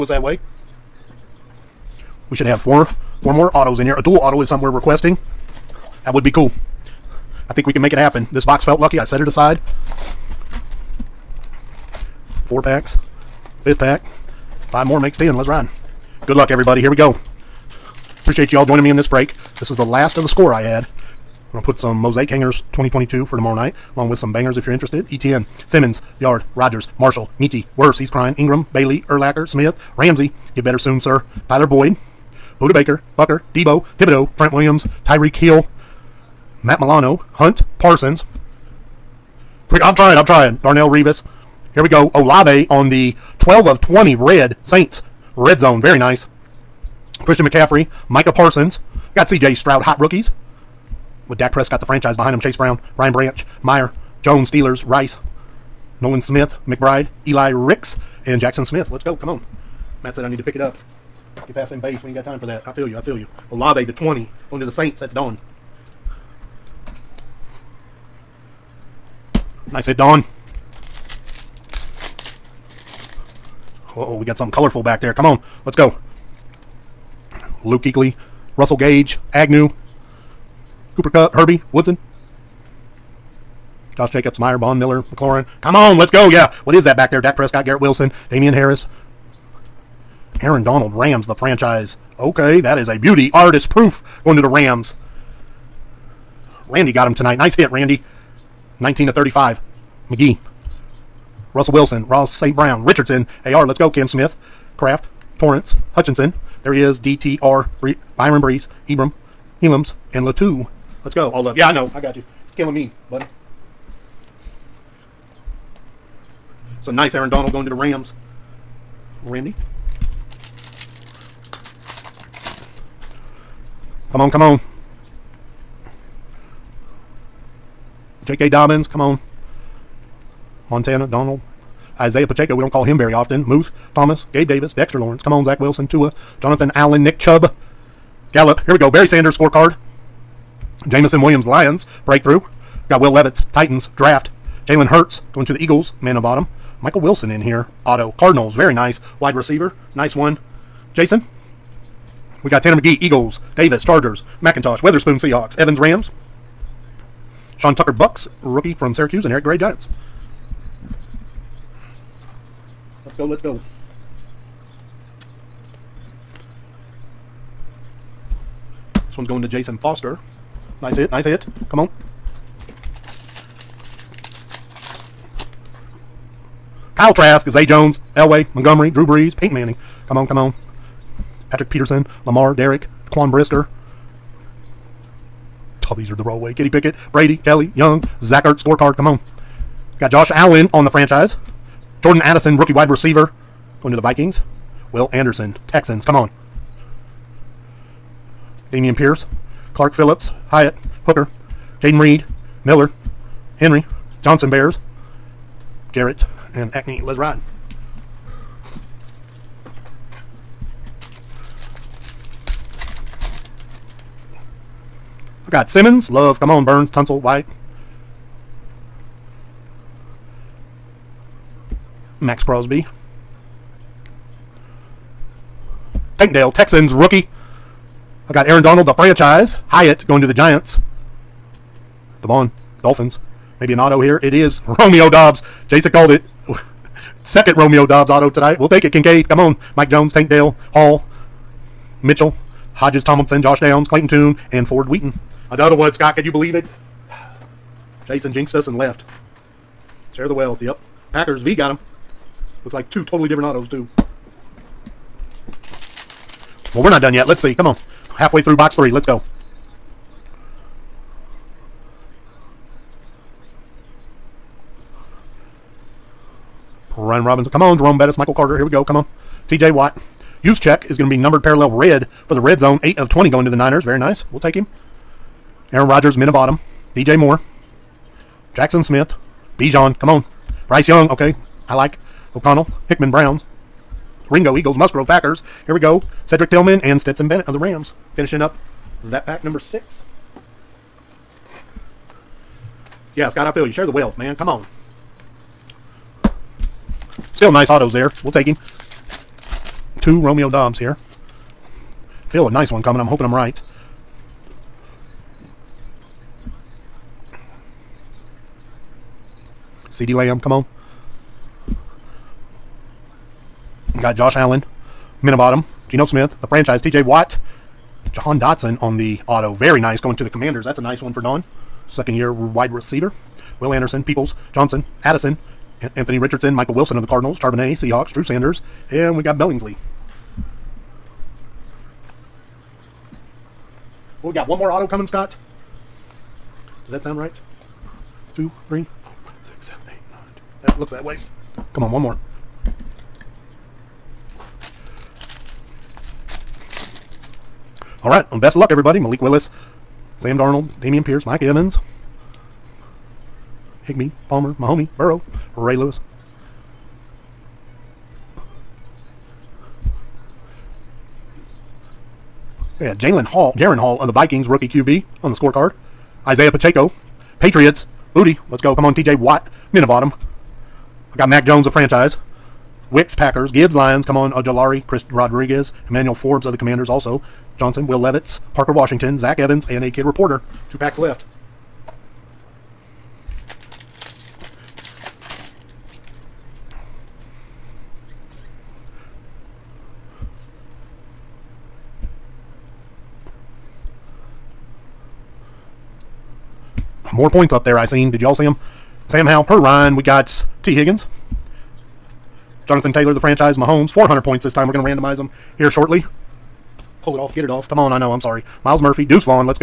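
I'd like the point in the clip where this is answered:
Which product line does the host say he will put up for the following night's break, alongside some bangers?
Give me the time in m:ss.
0:21.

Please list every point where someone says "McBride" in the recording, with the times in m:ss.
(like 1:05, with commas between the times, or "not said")
0:56.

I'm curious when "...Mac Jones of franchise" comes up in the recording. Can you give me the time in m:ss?
6:11.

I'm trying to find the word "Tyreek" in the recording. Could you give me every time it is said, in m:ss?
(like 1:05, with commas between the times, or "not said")
0:35.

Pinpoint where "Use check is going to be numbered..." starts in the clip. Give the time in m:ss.
4:30.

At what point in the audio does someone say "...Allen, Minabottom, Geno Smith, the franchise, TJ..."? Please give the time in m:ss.
5:14.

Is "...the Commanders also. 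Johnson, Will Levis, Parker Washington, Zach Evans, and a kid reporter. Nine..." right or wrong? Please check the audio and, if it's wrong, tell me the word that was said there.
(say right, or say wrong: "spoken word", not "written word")
wrong: "Two", not "Nine".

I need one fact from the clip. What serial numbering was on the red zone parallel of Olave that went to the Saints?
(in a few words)
12 of 20.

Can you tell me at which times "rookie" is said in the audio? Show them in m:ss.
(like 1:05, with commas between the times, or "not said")
0:49, 2:38, 3:12, 3:46, 6:04.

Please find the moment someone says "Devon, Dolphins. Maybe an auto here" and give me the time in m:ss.
3:52.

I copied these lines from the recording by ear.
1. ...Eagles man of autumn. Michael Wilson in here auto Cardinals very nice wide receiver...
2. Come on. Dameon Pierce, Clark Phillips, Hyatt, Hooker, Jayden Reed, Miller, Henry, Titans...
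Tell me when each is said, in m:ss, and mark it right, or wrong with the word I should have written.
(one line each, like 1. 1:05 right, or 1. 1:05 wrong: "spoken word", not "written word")
1. 2:25 right
2. 3:16 wrong: "Johnson", not "Titans".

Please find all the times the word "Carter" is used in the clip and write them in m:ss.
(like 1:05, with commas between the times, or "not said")
4:28.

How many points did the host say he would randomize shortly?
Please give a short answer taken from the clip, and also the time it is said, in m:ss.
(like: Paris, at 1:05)
400, at 6:43.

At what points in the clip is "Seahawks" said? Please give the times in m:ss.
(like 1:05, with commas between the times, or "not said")
2:35, 5:27.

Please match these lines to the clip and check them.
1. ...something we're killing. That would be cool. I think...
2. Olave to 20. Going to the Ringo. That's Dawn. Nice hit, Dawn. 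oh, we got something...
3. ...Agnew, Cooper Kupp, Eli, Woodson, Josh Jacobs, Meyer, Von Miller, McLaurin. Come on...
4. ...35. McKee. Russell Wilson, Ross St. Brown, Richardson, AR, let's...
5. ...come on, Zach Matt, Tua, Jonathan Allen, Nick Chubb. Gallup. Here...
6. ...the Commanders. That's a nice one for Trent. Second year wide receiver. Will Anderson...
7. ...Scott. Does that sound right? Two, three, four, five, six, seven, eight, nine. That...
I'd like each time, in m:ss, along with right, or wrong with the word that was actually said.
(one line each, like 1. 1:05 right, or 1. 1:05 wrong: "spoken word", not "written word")
1. 0:04 wrong: "requesting", not "killing"
2. 1:03 wrong: "Saints", not "Ringo"
3. 1:19 wrong: "Herbie", not "Eli"
4. 1:39 right
5. 2:15 wrong: "Wilson", not "Matt"
6. 5:20 wrong: "Don", not "Trent"
7. 5:35 right.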